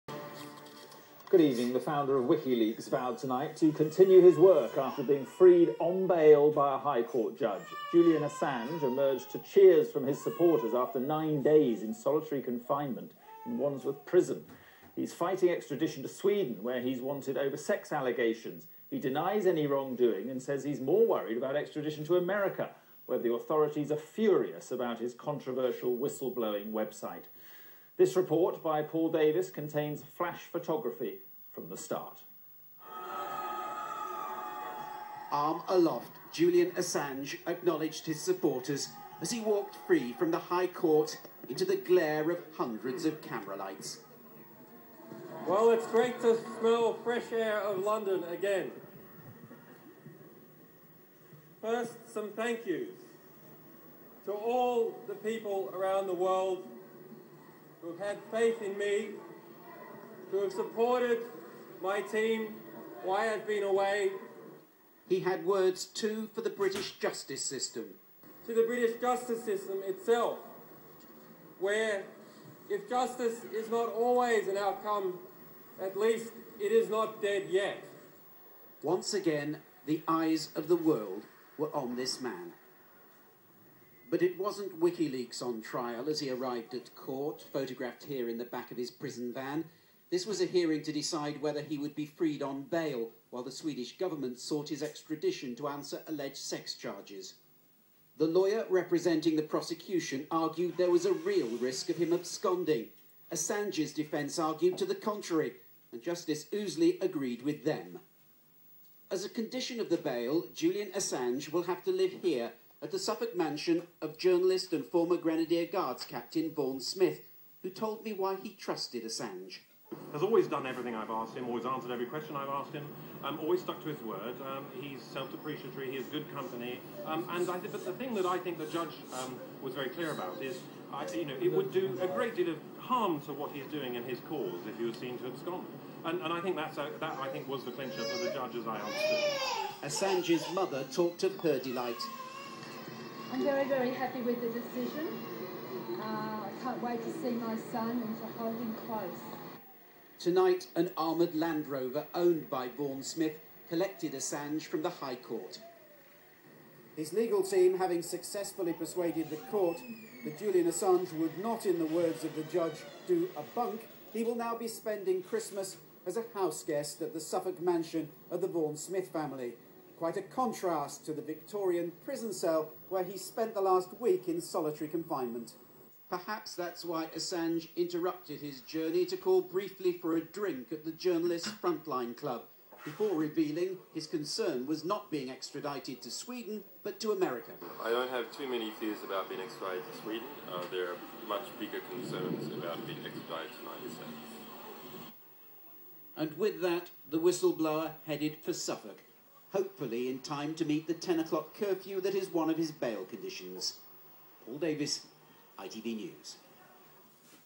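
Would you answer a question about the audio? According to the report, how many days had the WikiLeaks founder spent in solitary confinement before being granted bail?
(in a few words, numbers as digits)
9.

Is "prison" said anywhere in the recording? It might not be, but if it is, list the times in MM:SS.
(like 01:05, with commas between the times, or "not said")
00:14, 01:28, 02:52.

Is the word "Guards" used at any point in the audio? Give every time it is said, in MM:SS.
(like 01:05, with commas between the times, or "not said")
01:55.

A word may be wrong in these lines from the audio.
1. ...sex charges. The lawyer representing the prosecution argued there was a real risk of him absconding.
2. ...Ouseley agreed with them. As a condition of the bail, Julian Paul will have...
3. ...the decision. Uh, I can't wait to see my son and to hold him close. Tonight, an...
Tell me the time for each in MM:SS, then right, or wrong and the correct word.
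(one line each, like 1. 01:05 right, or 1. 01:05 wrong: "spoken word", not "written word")
1. 01:36 right
2. 01:46 wrong: "Assange", not "Paul"
3. 02:24 right.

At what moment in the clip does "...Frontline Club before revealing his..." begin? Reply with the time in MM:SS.
03:01.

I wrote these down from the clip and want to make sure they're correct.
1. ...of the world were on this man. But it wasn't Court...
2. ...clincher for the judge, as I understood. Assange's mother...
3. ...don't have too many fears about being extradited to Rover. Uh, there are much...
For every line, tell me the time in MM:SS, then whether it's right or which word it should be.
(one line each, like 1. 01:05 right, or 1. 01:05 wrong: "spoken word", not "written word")
1. 01:20 wrong: "WikiLeaks", not "Court"
2. 02:17 right
3. 03:07 wrong: "Sweden", not "Rover".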